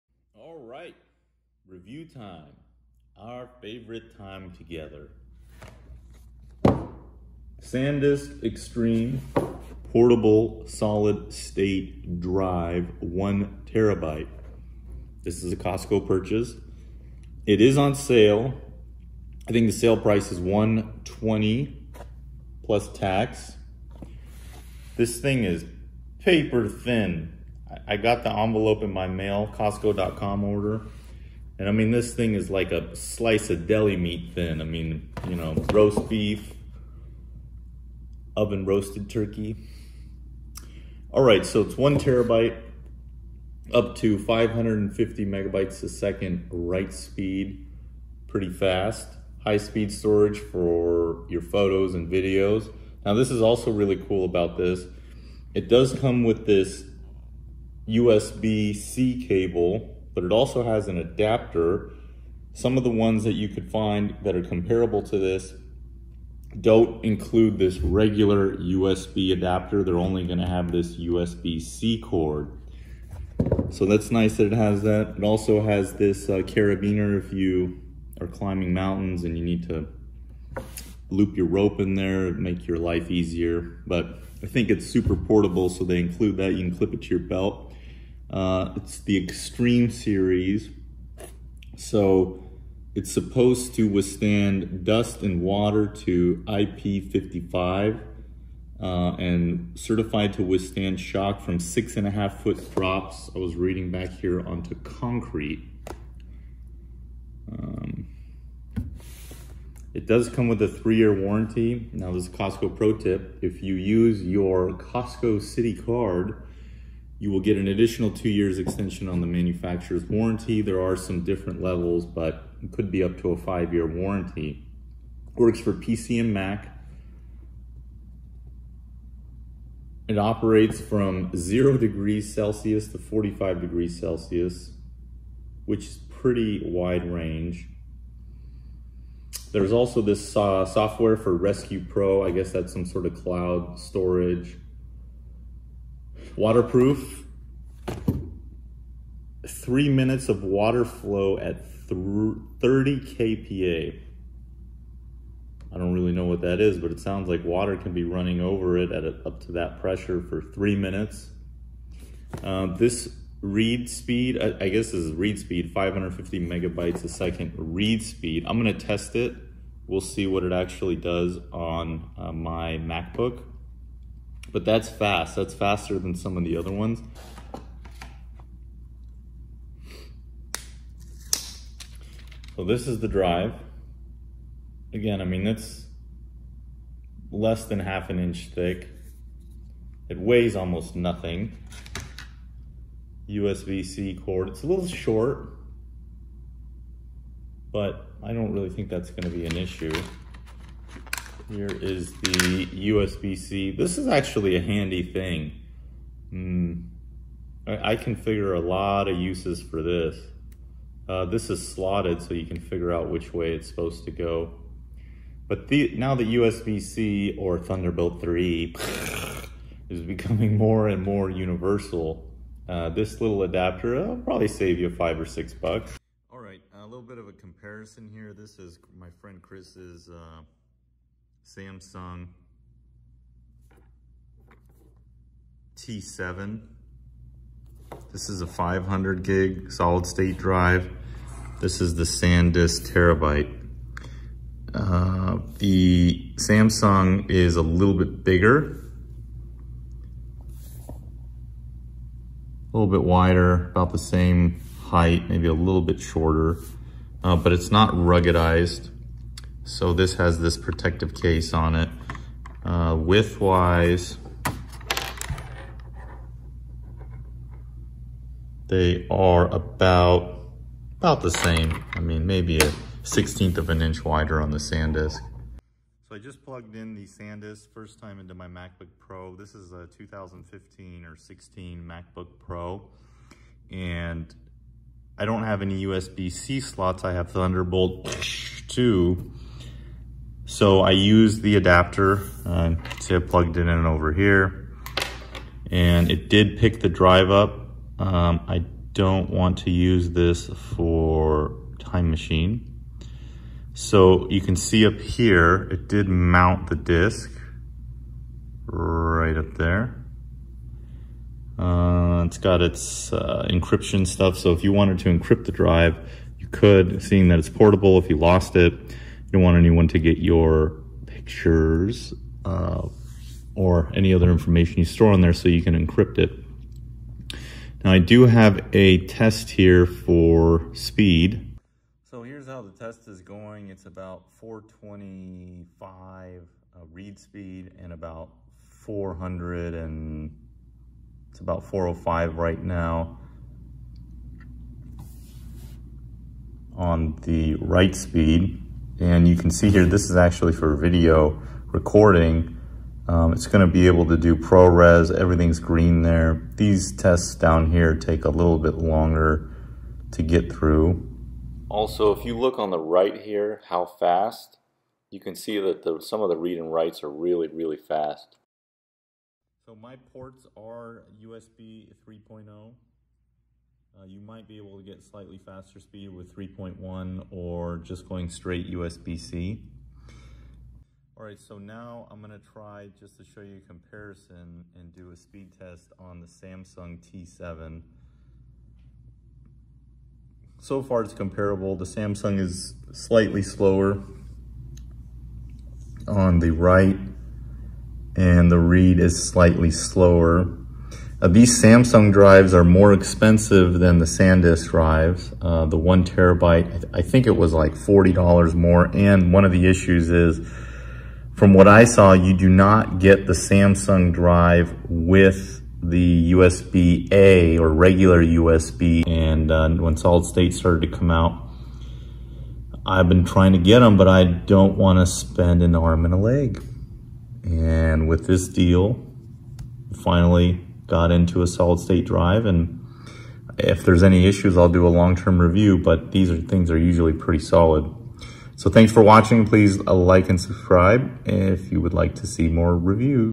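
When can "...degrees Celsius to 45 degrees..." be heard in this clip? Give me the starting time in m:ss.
2:11.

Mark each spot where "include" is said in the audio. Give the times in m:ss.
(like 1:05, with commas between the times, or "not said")
1:07, 1:25.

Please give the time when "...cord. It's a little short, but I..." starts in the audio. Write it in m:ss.
3:14.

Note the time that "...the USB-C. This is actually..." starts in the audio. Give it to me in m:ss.
3:22.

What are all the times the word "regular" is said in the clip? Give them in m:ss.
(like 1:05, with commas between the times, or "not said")
1:07, 6:57.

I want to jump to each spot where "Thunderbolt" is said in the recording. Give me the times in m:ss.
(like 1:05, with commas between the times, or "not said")
3:37, 4:47.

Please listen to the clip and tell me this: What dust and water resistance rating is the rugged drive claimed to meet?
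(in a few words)
IP55.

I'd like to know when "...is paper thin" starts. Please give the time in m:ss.
0:25.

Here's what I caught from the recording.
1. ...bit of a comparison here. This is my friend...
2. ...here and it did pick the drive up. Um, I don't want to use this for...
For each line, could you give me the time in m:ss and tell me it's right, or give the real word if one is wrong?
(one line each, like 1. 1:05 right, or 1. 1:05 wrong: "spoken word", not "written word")
1. 3:47 right
2. 4:54 right.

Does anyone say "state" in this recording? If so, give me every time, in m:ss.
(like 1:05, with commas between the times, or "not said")
0:11, 4:00, 7:00, 7:11.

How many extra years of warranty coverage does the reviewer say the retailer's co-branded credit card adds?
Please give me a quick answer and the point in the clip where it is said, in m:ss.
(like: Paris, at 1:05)
2 years, at 1:58.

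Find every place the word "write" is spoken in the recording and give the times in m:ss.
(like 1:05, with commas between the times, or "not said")
0:46, 5:47, 6:06, 6:36.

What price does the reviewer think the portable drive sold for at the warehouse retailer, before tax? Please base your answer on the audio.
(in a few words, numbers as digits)
120.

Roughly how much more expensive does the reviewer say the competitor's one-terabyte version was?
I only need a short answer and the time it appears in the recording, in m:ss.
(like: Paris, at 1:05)
$40, at 6:47.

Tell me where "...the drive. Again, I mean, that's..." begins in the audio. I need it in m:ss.
3:02.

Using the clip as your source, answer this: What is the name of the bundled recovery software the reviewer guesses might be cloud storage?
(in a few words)
Rescue Pro.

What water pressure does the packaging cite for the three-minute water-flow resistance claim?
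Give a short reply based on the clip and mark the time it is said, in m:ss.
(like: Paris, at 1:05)
30 kPa, at 2:31.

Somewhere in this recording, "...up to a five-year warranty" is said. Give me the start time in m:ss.
2:03.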